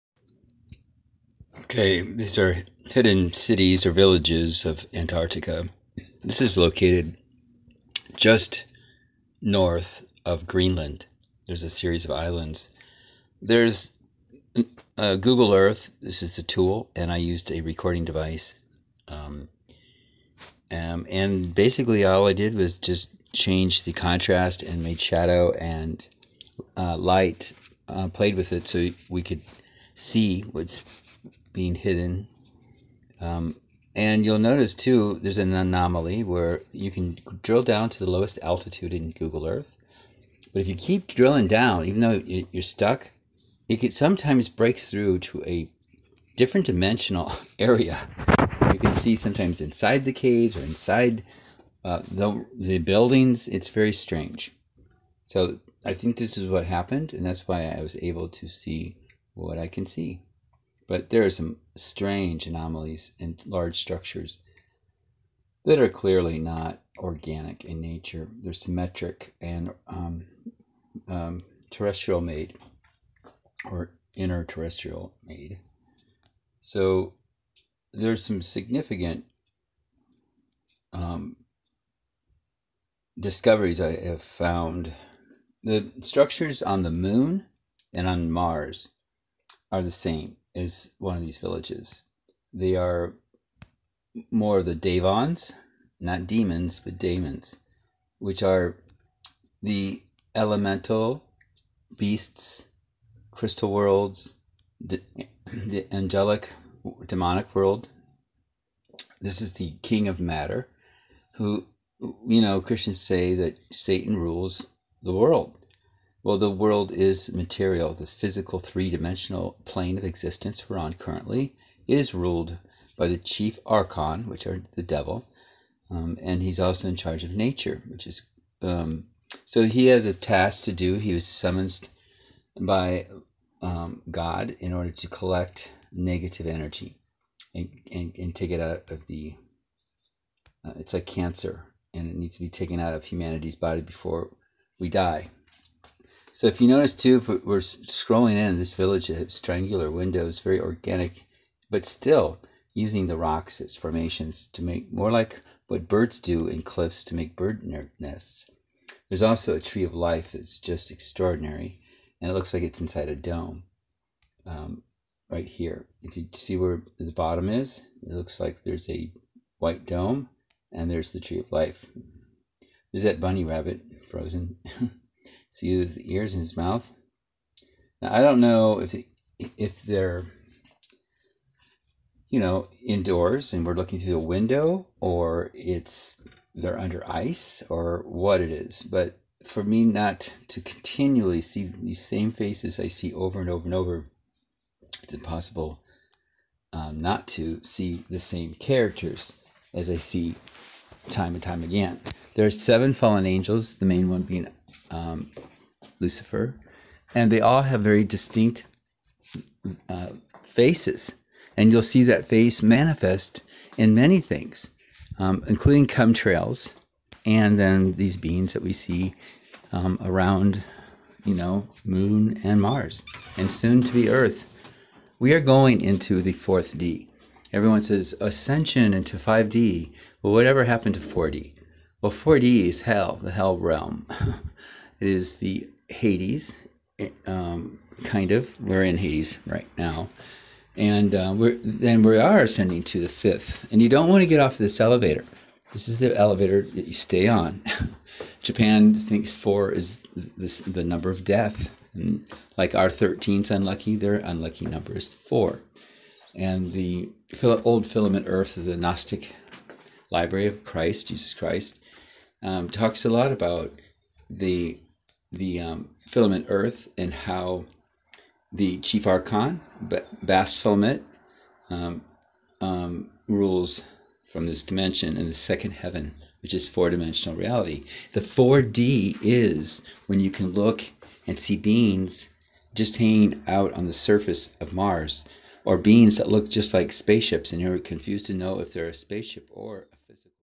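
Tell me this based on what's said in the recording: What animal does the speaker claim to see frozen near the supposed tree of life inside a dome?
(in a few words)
Bunny rabbit.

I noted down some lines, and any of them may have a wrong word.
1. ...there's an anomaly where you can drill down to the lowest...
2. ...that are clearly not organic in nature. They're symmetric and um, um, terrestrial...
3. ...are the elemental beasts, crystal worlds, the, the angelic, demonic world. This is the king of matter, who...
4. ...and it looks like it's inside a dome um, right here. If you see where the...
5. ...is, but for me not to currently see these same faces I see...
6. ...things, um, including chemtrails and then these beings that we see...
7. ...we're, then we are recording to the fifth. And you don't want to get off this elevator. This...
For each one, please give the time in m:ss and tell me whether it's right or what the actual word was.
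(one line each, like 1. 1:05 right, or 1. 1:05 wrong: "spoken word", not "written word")
1. 0:35 right
2. 1:05 right
3. 1:38 right
4. 2:42 right
5. 3:08 wrong: "continually", not "currently"
6. 3:34 right
7. 4:01 wrong: "ascending", not "recording".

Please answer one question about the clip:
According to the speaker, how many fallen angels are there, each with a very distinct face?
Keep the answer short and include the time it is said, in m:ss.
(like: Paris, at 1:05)
7, at 3:22.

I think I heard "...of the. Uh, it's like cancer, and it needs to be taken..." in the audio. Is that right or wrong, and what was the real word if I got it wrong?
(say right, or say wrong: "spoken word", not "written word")
right.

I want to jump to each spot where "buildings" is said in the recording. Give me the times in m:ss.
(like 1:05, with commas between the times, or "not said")
0:52.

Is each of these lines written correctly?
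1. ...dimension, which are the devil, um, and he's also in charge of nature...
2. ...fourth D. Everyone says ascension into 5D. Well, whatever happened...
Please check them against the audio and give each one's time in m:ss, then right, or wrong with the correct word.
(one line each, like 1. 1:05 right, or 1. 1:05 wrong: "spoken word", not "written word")
1. 2:03 wrong: "archon", not "dimension"
2. 3:46 right.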